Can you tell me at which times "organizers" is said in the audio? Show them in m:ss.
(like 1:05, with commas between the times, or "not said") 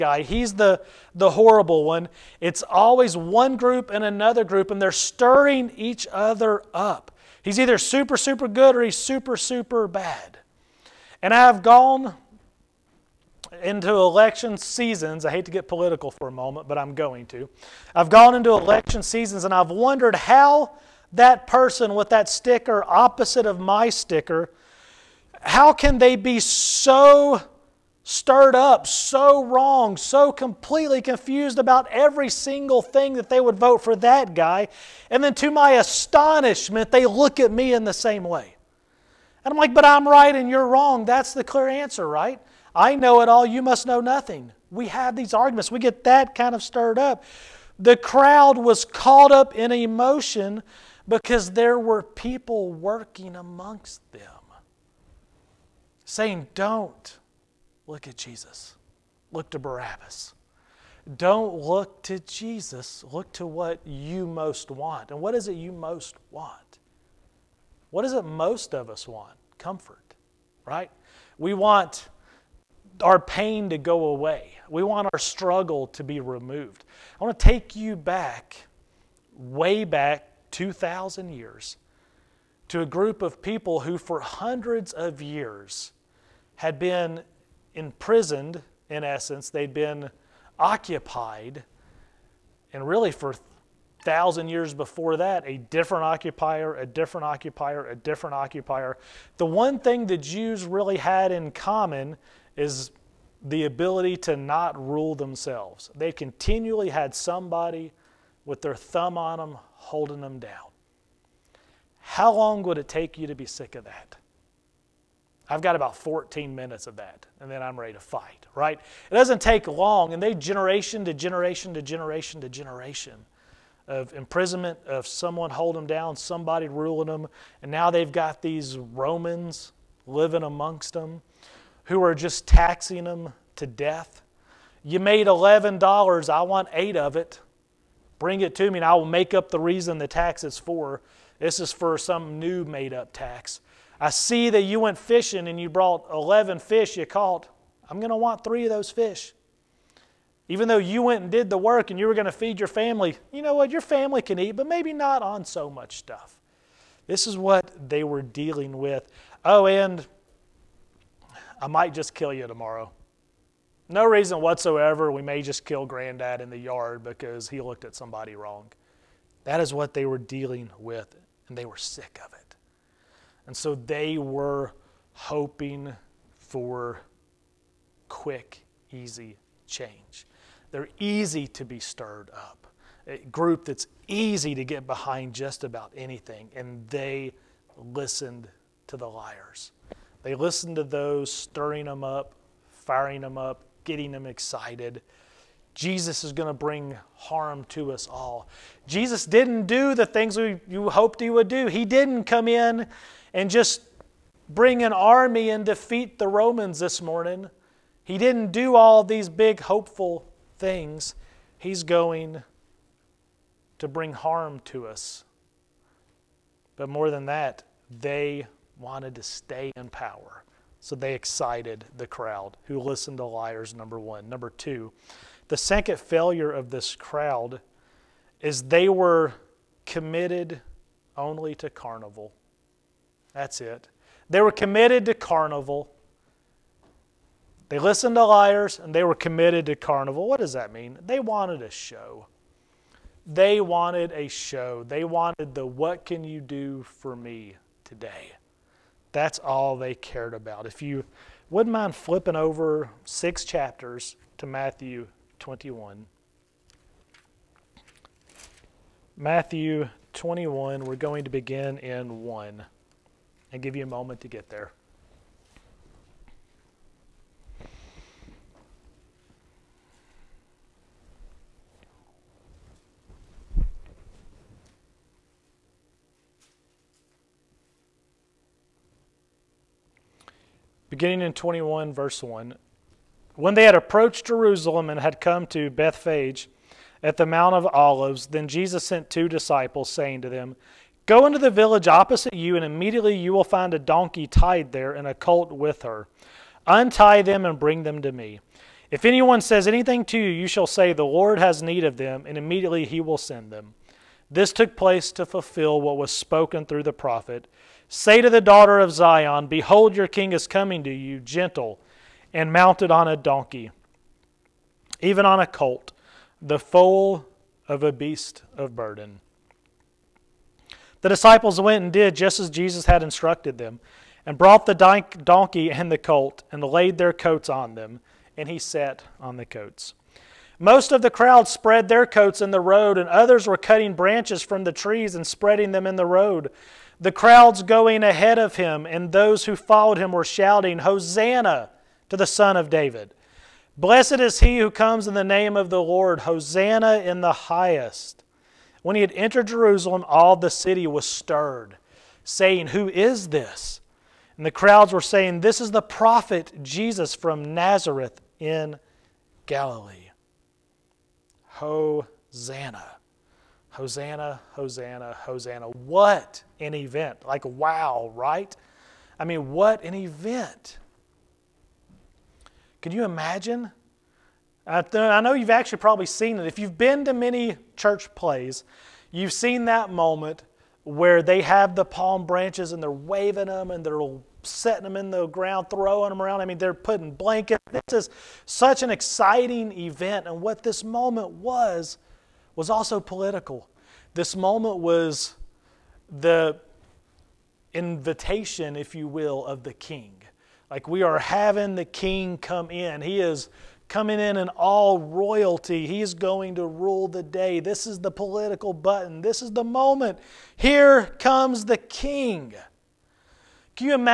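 not said.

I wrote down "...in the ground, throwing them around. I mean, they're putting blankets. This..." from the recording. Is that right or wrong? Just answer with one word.
right.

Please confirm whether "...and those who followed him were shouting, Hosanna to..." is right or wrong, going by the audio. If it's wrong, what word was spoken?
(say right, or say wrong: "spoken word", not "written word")
right.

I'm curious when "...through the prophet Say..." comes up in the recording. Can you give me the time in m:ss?
5:06.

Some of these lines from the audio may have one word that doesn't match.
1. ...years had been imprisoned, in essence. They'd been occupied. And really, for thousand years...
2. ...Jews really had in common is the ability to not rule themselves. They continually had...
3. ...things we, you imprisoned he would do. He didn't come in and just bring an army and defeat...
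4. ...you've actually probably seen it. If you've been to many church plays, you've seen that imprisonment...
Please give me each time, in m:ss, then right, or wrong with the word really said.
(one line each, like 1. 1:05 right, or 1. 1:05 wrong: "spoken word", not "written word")
1. 1:25 right
2. 1:40 right
3. 3:20 wrong: "hoped", not "imprisoned"
4. 6:15 wrong: "moment", not "imprisonment".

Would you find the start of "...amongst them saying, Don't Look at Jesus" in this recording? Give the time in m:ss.
0:53.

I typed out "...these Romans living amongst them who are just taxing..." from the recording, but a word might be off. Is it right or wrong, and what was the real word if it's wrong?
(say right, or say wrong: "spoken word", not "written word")
right.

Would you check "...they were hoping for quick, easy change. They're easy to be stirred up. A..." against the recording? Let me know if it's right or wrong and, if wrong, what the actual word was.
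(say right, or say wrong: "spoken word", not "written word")
right.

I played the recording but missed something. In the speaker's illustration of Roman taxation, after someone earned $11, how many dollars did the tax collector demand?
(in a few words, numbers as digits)
8.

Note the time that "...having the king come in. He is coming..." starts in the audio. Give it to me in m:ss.
6:41.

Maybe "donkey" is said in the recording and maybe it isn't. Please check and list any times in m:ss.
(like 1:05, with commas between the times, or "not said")
4:53, 5:13, 5:24.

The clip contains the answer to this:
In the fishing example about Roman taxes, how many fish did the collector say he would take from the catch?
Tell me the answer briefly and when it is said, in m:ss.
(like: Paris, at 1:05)
3, at 2:28.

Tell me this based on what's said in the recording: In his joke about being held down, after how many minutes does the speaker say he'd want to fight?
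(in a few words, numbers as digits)
14.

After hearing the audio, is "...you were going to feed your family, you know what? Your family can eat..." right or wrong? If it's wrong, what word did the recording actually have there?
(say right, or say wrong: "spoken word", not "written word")
right.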